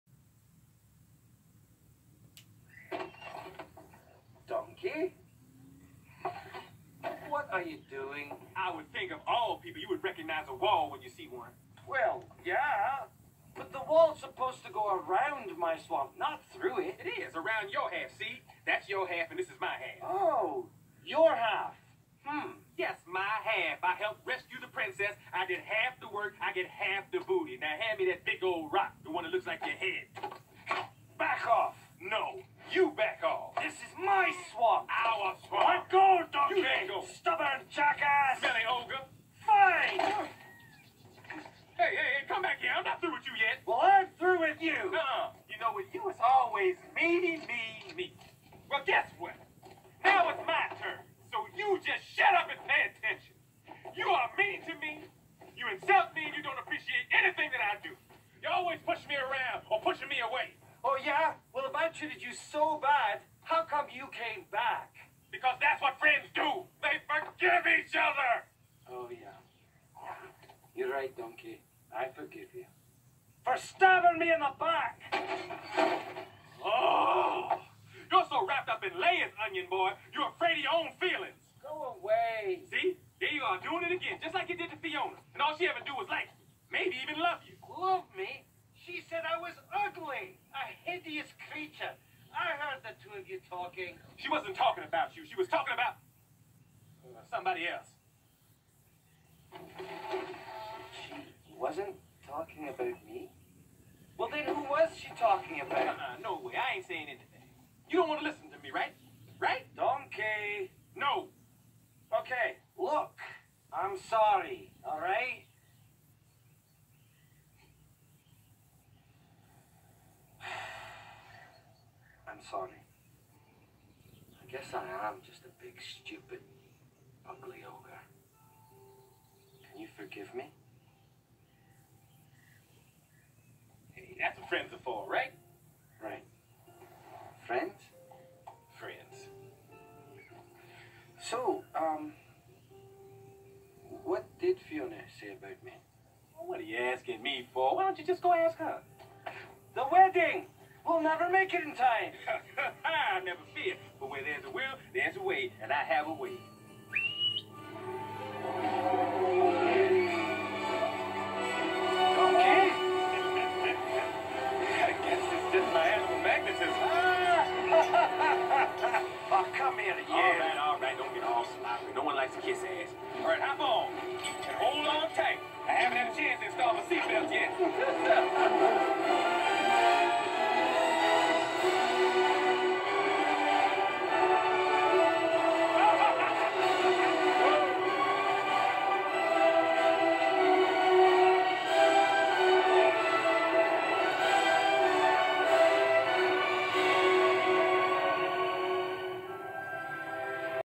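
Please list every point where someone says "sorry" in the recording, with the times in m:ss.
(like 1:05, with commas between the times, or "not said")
1:54, 2:02.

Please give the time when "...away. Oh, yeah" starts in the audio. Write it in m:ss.
1:00.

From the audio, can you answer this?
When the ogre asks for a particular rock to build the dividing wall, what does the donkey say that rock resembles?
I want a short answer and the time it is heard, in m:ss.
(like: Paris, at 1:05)
Your head, at 0:29.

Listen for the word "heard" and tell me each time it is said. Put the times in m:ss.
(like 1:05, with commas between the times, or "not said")
1:32.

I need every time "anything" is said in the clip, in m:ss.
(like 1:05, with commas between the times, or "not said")
0:57, 1:47.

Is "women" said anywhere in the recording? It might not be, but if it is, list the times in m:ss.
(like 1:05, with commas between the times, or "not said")
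not said.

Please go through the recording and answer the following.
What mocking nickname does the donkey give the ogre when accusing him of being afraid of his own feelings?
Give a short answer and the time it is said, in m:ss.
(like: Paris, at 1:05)
Onion boy, at 1:19.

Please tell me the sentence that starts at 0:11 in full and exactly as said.
Well, yeah, but the wall's supposed to go around my swamp, not through it.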